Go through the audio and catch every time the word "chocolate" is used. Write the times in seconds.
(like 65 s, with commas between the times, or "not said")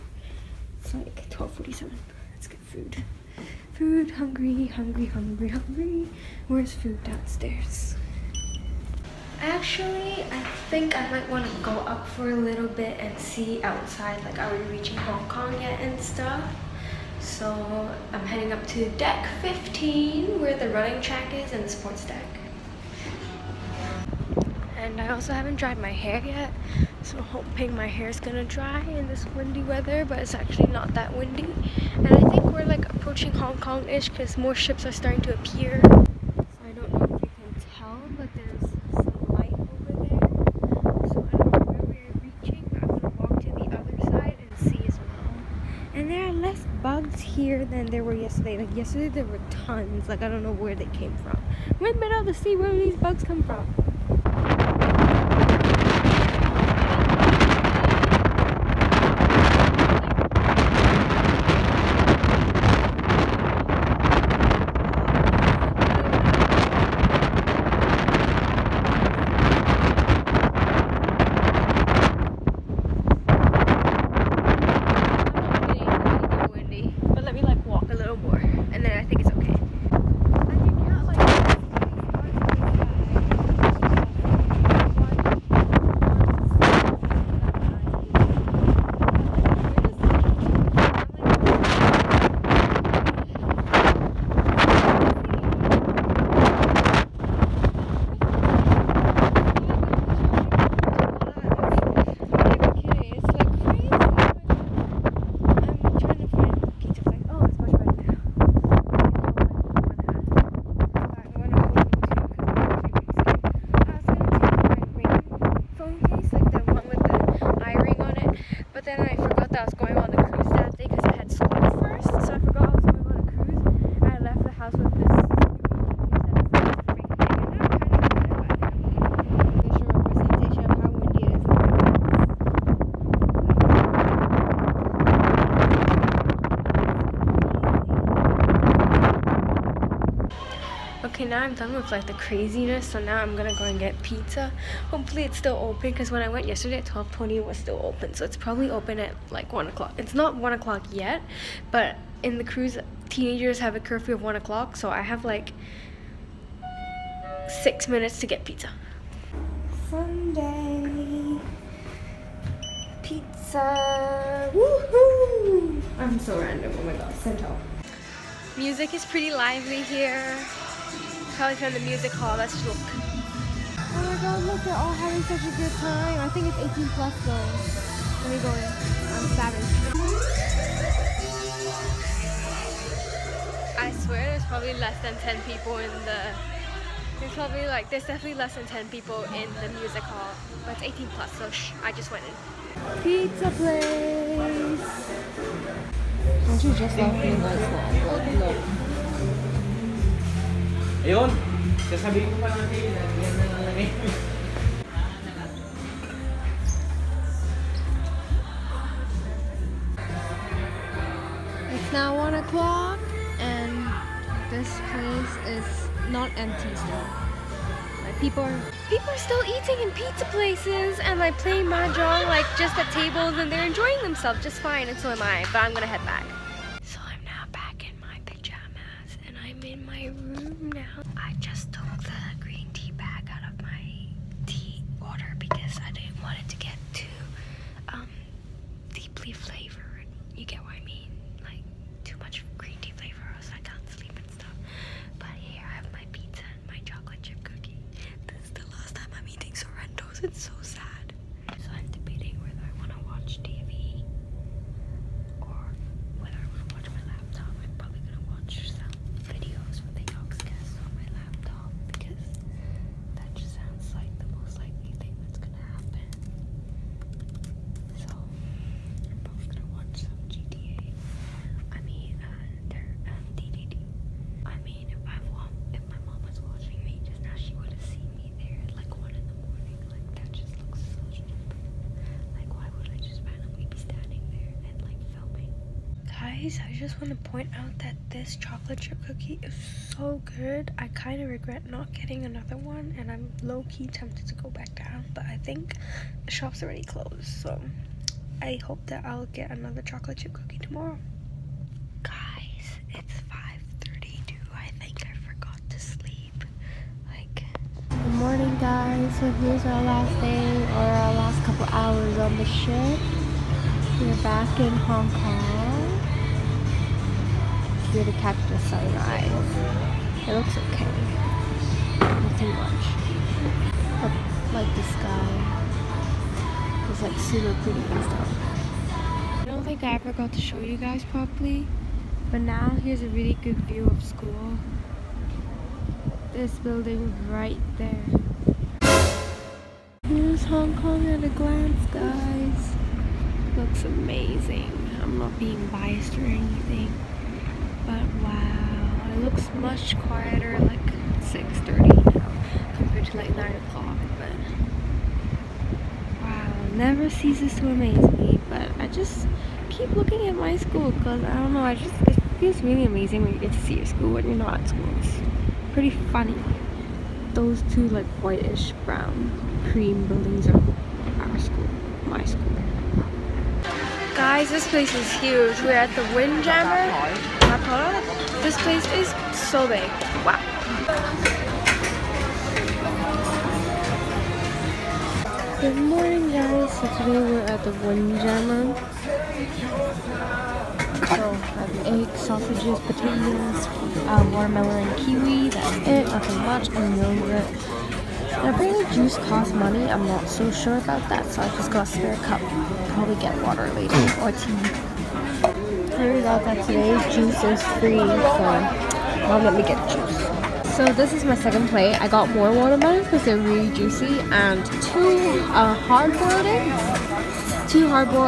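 288 s, 299 s.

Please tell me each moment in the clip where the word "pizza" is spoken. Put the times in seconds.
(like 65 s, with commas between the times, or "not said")
144 s, 158 s, 163 s, 193 s, 219 s.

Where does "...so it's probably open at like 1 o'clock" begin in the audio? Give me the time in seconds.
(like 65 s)
148 s.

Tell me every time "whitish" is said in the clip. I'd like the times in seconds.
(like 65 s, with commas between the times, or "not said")
368 s.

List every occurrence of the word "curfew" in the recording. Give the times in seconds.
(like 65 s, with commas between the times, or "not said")
153 s.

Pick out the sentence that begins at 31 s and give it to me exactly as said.
And I think we're like approaching Hong Kong-ish because more ships are starting to appear.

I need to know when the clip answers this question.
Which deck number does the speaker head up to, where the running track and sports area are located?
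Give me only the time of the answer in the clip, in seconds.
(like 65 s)
18 s.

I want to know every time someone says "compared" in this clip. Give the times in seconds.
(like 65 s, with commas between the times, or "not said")
352 s.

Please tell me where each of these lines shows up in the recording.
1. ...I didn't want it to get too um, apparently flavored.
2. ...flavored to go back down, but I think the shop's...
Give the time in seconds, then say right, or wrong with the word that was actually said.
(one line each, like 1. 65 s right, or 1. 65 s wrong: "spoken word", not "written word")
1. 235 s wrong: "deeply", not "apparently"
2. 293 s wrong: "tempted", not "flavored".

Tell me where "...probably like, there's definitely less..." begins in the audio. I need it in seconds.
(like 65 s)
187 s.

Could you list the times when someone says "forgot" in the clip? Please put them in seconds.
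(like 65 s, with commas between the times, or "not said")
119 s, 305 s.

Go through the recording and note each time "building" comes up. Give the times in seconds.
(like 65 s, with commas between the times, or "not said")
336 s, 370 s.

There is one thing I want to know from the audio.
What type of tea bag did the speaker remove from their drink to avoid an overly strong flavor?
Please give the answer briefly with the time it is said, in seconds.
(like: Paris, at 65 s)
green tea, at 232 s.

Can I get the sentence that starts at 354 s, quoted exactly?
But wow, never ceases to amaze me.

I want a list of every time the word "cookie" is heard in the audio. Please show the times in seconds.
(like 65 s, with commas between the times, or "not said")
289 s, 300 s.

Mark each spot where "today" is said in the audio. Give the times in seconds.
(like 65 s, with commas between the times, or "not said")
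386 s, 406 s.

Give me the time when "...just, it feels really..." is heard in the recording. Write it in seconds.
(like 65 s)
361 s.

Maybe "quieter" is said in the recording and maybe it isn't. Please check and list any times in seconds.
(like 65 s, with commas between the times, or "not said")
349 s.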